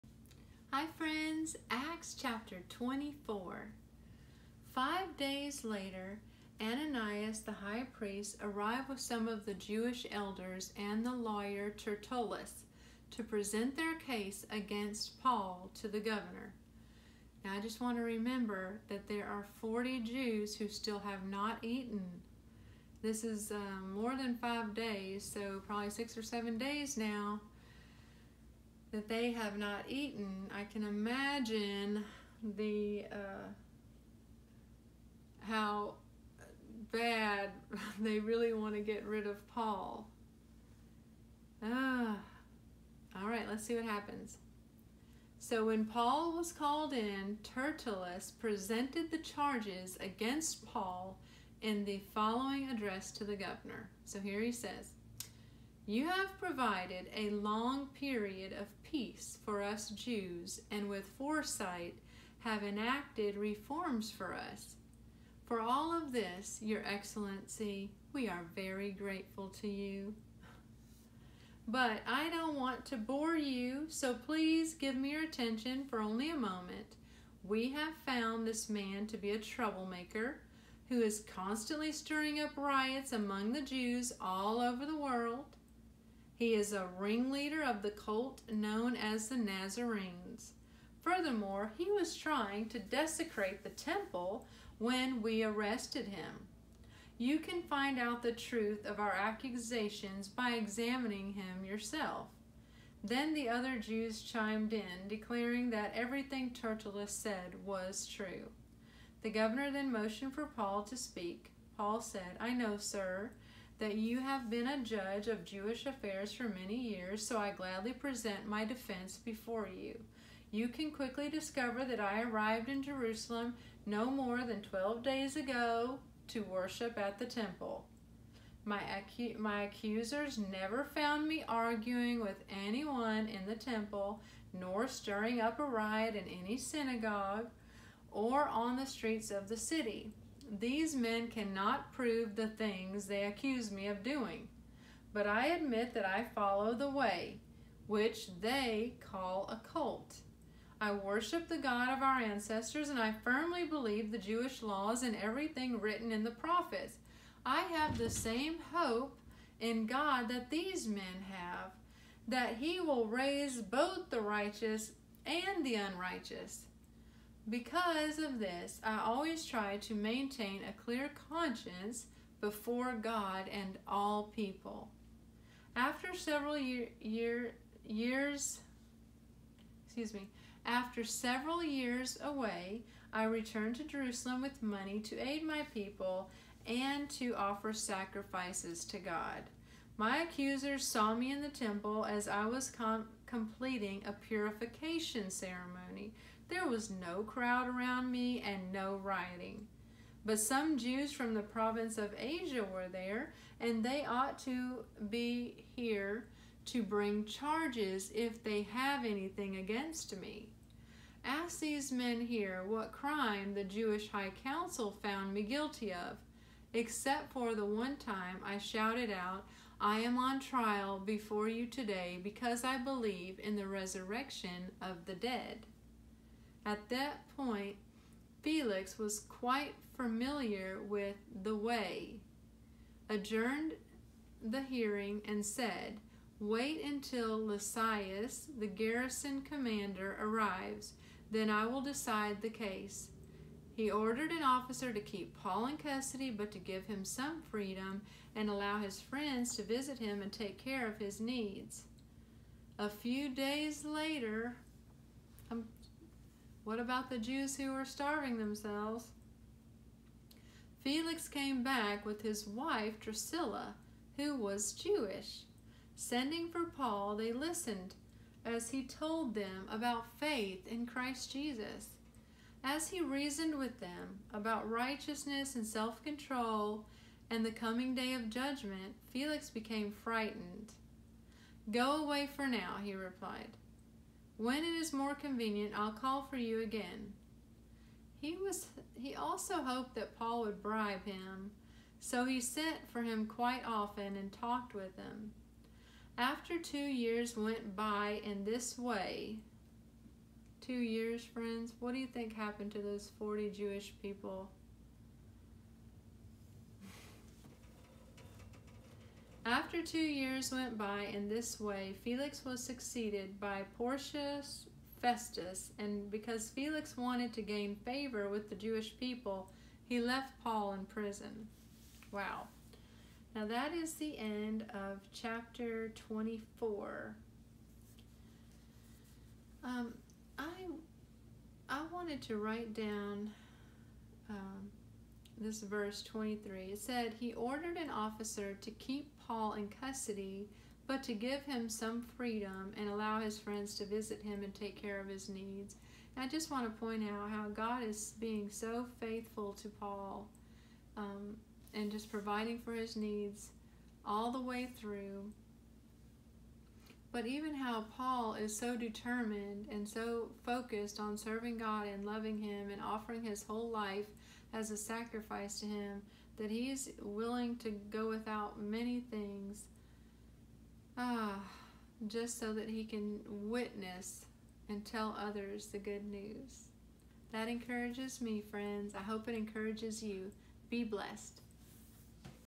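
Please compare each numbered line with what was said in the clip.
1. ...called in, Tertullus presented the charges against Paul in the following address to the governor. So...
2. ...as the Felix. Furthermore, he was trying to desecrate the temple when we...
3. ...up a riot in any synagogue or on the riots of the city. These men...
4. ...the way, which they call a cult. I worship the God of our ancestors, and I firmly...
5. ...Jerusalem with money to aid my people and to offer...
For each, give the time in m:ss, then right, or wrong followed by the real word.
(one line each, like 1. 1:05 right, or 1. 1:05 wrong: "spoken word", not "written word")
1. 0:46 right
2. 1:28 wrong: "Nazarenes", not "Felix"
3. 2:15 wrong: "streets", not "riots"
4. 2:26 right
5. 3:03 right.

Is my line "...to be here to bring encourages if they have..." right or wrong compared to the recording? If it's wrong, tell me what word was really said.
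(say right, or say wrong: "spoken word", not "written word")
wrong: "charges", not "encourages".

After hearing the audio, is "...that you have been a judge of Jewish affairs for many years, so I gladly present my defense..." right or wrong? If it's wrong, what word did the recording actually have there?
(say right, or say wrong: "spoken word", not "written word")
right.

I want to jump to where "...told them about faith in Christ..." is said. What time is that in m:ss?
4:28.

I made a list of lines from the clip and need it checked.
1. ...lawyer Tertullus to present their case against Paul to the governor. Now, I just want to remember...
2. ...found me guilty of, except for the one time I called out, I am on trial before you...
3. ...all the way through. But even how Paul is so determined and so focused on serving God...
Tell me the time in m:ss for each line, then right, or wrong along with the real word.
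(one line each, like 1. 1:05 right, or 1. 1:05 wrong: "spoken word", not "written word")
1. 0:11 right
2. 3:35 wrong: "shouted", not "called"
3. 5:54 right.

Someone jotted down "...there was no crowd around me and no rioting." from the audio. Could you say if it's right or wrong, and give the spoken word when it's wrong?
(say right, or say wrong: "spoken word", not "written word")
right.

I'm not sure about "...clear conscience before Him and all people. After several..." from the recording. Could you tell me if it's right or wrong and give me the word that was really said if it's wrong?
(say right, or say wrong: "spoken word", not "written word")
wrong: "God", not "Him".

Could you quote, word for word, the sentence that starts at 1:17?
We have found this man to be a troublemaker who is constantly stirring up riots among the Jews all over the world.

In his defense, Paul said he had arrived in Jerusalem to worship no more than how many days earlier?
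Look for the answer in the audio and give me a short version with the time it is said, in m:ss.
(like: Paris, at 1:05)
12, at 2:04.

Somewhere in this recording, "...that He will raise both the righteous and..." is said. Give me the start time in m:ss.
2:42.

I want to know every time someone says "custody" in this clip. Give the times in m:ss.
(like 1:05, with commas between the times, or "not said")
4:05, 5:39.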